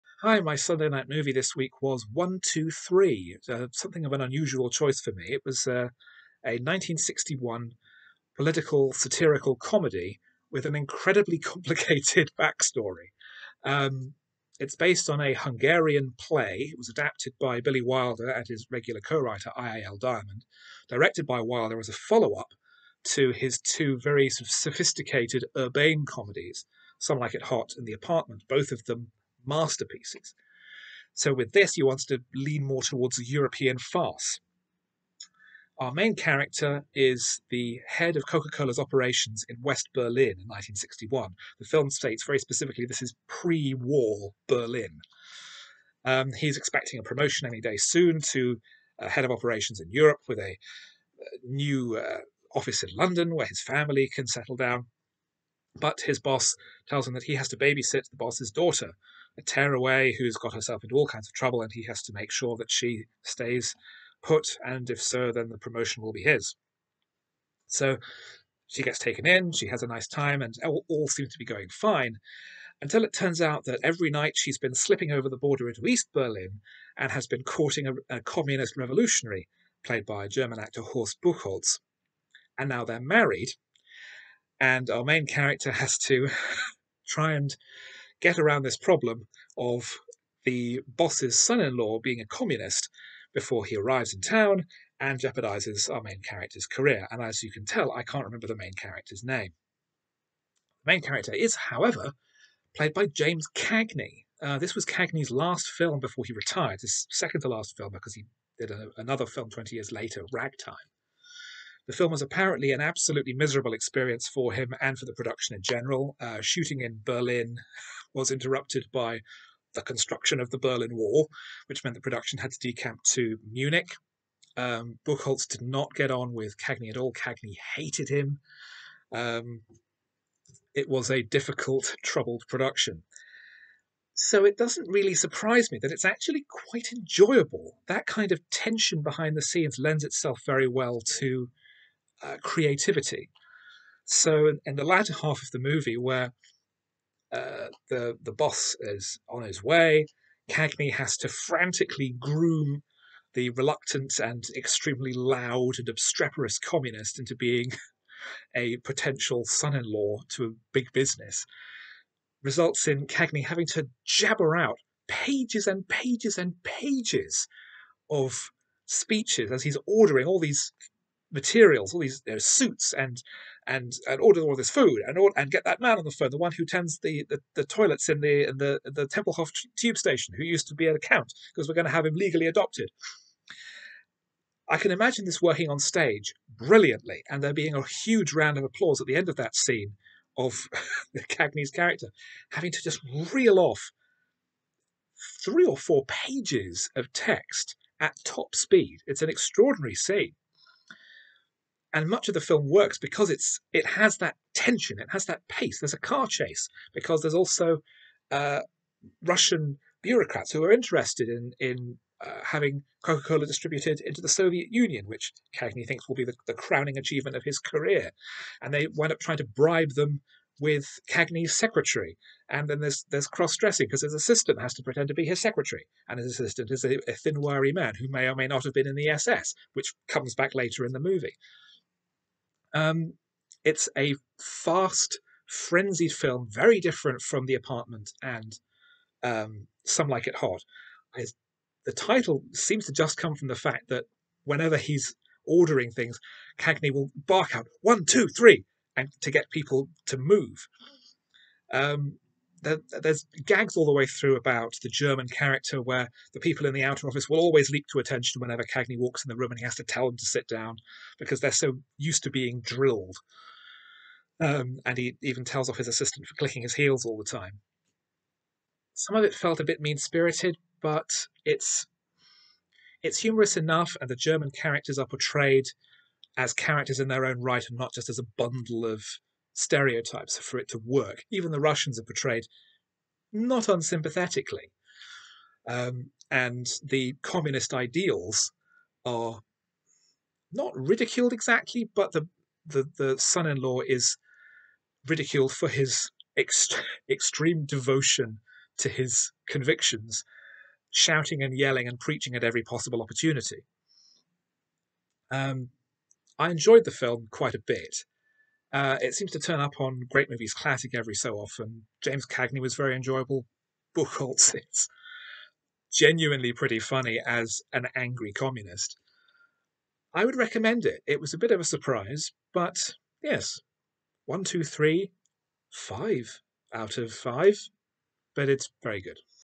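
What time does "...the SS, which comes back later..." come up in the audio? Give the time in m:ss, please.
3:48.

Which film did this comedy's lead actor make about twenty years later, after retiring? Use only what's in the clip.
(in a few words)
Ragtime.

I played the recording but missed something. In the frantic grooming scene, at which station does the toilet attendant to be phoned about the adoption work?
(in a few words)
Tempelhof.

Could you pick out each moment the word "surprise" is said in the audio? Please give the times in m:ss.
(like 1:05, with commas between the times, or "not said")
2:15, 5:21.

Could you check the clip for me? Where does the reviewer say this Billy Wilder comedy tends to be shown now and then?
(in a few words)
Great Movies Classic.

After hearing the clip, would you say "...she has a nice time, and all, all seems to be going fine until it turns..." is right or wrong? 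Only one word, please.
right.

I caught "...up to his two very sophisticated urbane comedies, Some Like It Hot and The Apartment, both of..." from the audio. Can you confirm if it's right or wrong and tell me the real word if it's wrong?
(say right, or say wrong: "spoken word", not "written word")
right.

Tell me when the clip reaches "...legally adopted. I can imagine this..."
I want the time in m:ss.
3:02.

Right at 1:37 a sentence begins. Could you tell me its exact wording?
And as you can tell, I can't remember the main character's name.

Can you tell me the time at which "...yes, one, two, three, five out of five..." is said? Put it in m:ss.
5:23.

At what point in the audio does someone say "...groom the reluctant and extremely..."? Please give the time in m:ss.
2:32.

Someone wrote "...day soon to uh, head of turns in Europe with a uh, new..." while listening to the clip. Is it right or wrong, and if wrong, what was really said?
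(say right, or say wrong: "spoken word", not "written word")
wrong: "operations", not "turns".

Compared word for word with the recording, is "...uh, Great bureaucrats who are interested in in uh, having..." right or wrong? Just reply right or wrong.
wrong.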